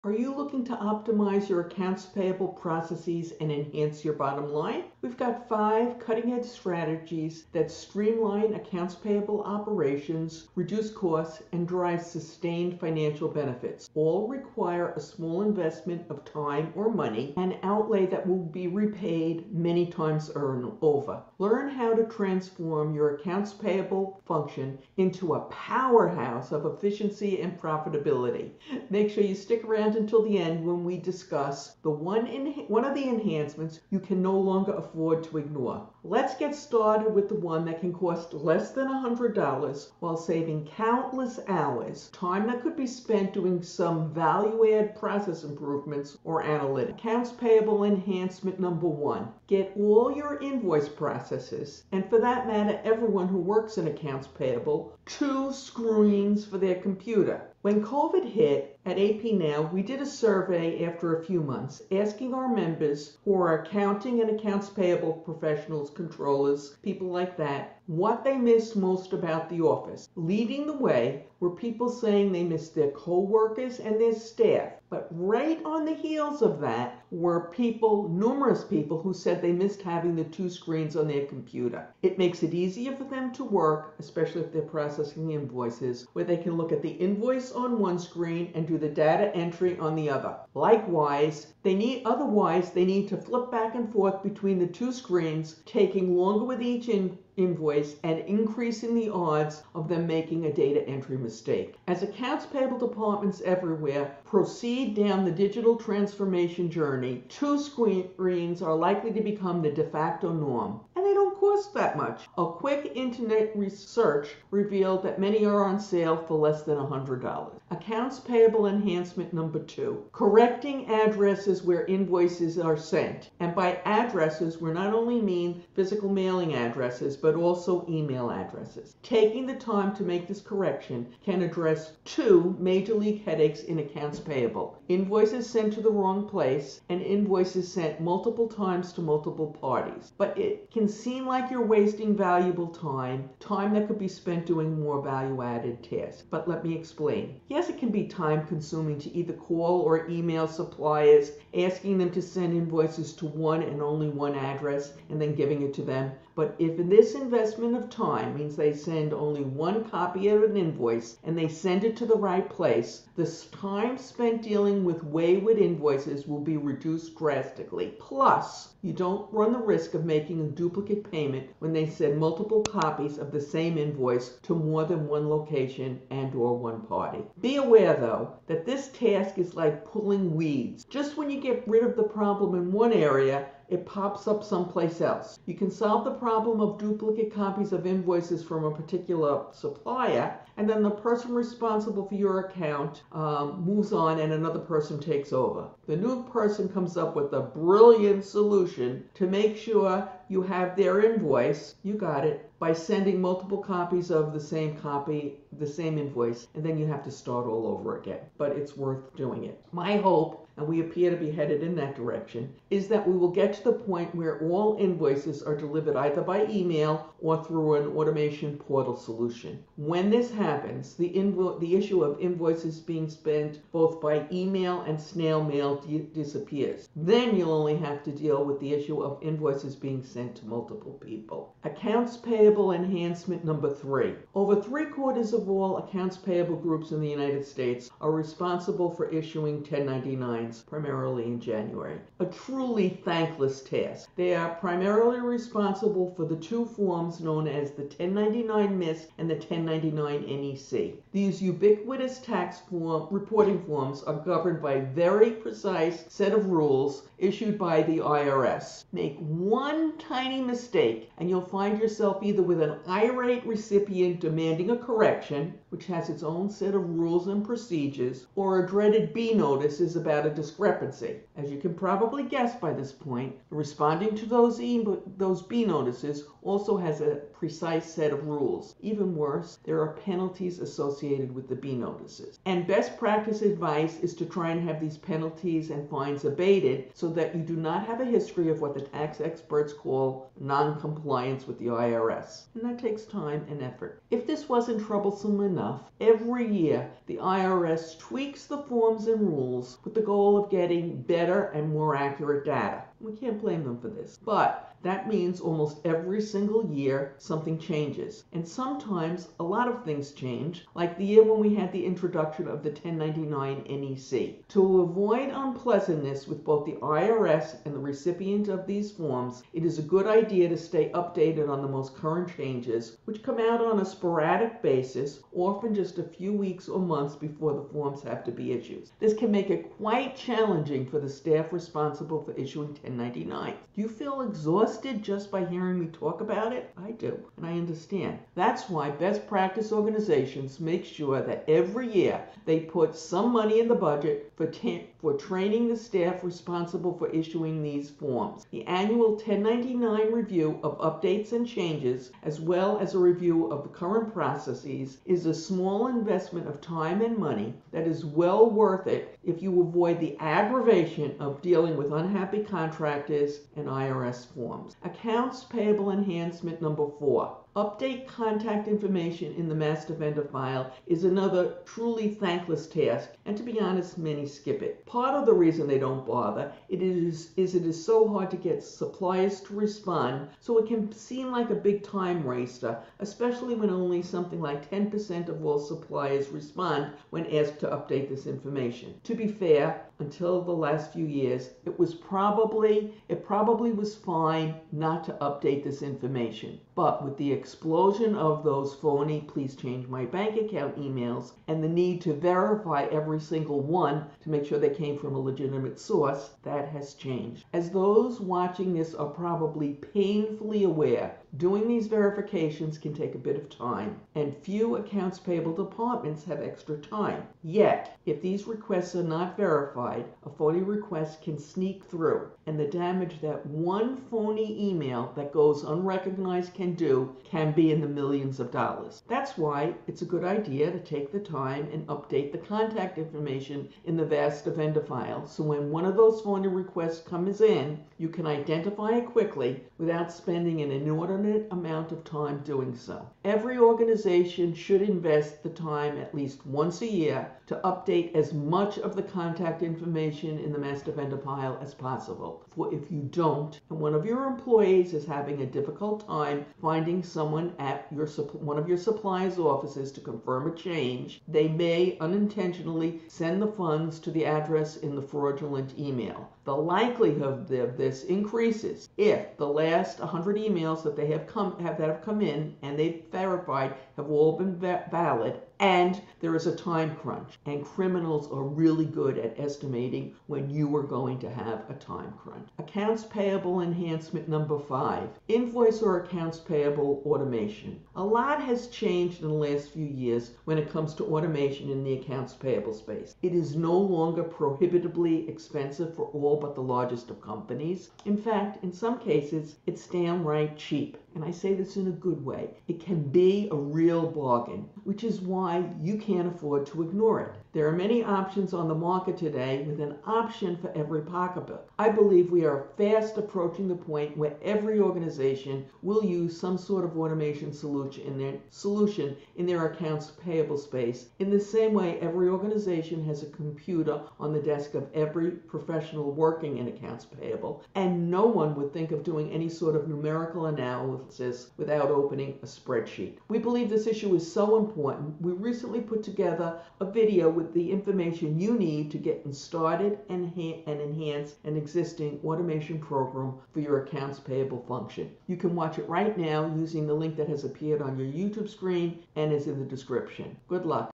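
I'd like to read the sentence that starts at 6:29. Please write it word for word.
To be fair, until the last few years, it was probably it probably was fine not to update this information.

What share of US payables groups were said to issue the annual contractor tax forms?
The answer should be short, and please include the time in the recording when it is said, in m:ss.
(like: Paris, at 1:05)
over three quarters, at 3:54.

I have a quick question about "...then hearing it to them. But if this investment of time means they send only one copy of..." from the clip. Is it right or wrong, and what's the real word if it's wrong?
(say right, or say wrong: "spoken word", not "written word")
wrong: "giving", not "hearing".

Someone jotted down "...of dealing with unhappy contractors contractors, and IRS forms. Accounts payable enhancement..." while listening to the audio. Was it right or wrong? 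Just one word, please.
right.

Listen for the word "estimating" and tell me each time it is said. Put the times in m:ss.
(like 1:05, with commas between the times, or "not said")
7:59.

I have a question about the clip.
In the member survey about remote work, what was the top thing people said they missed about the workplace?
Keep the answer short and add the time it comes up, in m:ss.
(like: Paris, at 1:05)
their co-workers, at 1:12.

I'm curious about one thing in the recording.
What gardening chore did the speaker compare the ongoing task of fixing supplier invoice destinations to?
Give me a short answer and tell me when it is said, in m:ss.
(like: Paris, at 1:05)
pulling weeds, at 2:59.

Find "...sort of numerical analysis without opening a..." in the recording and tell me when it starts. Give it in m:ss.
8:49.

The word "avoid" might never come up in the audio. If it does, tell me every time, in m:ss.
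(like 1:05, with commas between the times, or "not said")
5:14, 5:59.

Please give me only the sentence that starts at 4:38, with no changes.
Even worse, there are penalties associated with the B notices.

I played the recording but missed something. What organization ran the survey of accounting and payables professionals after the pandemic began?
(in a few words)
AP Now.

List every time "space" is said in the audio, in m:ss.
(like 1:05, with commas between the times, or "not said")
8:12, 8:40.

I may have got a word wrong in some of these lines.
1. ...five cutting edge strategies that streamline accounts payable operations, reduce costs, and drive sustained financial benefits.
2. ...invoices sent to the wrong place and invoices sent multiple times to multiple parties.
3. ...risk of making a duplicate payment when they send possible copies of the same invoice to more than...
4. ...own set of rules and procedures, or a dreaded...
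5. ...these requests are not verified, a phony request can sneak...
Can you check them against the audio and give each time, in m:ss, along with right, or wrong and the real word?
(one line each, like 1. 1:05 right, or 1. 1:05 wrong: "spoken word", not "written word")
1. 0:05 right
2. 2:14 right
3. 2:49 wrong: "multiple", not "possible"
4. 4:26 right
5. 6:58 right.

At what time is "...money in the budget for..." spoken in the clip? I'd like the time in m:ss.
5:43.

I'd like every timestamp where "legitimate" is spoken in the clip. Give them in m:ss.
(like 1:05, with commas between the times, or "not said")
6:45.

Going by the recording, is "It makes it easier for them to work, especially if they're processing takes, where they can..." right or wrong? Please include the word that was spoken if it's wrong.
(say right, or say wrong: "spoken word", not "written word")
wrong: "invoices", not "takes".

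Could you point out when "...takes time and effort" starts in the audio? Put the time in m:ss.
4:52.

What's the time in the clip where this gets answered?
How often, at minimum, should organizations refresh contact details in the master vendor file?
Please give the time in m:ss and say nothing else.
7:26.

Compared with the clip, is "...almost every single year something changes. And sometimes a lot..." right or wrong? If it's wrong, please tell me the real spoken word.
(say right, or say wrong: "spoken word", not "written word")
right.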